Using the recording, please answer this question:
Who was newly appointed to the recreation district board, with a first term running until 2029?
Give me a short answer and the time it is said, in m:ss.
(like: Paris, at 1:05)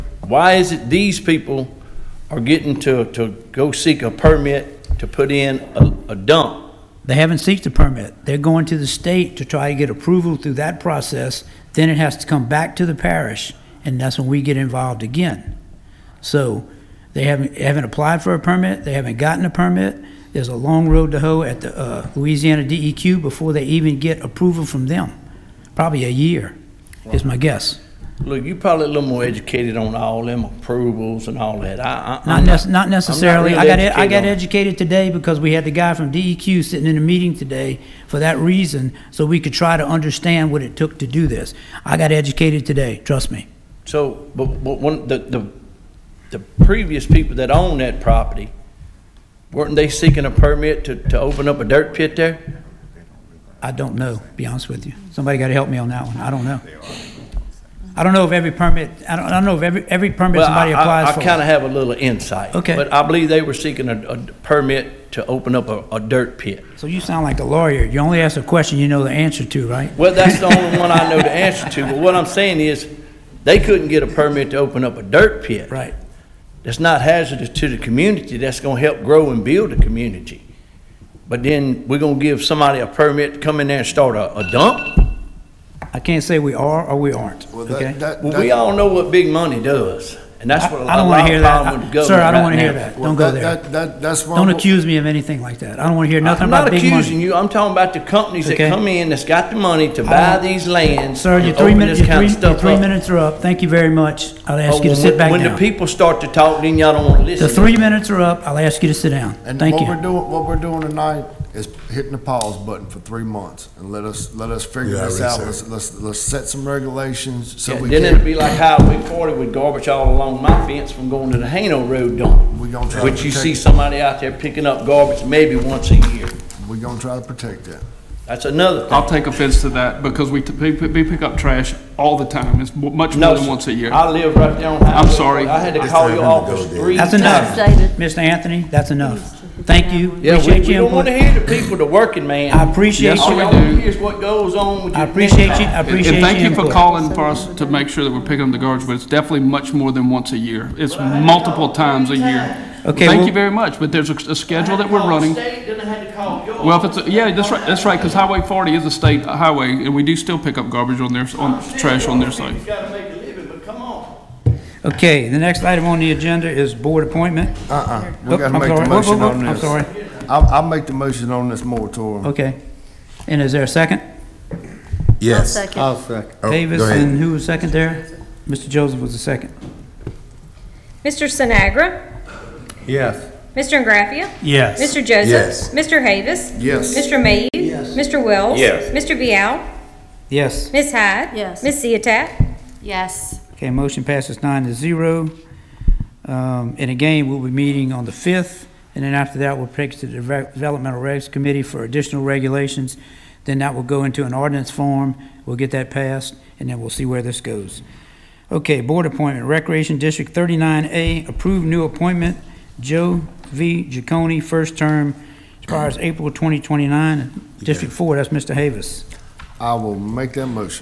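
Joe V. Giacone, at 3:32.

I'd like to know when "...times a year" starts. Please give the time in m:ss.
2:31.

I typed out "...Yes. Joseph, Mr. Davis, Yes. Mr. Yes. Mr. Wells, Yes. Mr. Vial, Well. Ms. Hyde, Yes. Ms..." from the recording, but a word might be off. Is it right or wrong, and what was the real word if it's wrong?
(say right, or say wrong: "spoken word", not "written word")
wrong: "Yes", not "Well".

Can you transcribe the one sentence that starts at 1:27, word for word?
that- Well, we all know what big money does.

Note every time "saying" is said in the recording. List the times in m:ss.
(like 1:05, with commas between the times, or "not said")
1:12.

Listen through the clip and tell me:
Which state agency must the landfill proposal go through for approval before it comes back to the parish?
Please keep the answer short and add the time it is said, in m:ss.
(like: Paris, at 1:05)
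Louisiana DEQ, at 0:22.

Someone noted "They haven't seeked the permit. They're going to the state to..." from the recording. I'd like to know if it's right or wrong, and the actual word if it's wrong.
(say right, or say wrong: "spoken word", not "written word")
right.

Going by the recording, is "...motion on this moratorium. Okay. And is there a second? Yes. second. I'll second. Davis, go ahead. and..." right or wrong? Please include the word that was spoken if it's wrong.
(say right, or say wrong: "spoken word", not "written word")
right.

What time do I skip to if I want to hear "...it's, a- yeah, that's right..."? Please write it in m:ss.
2:36.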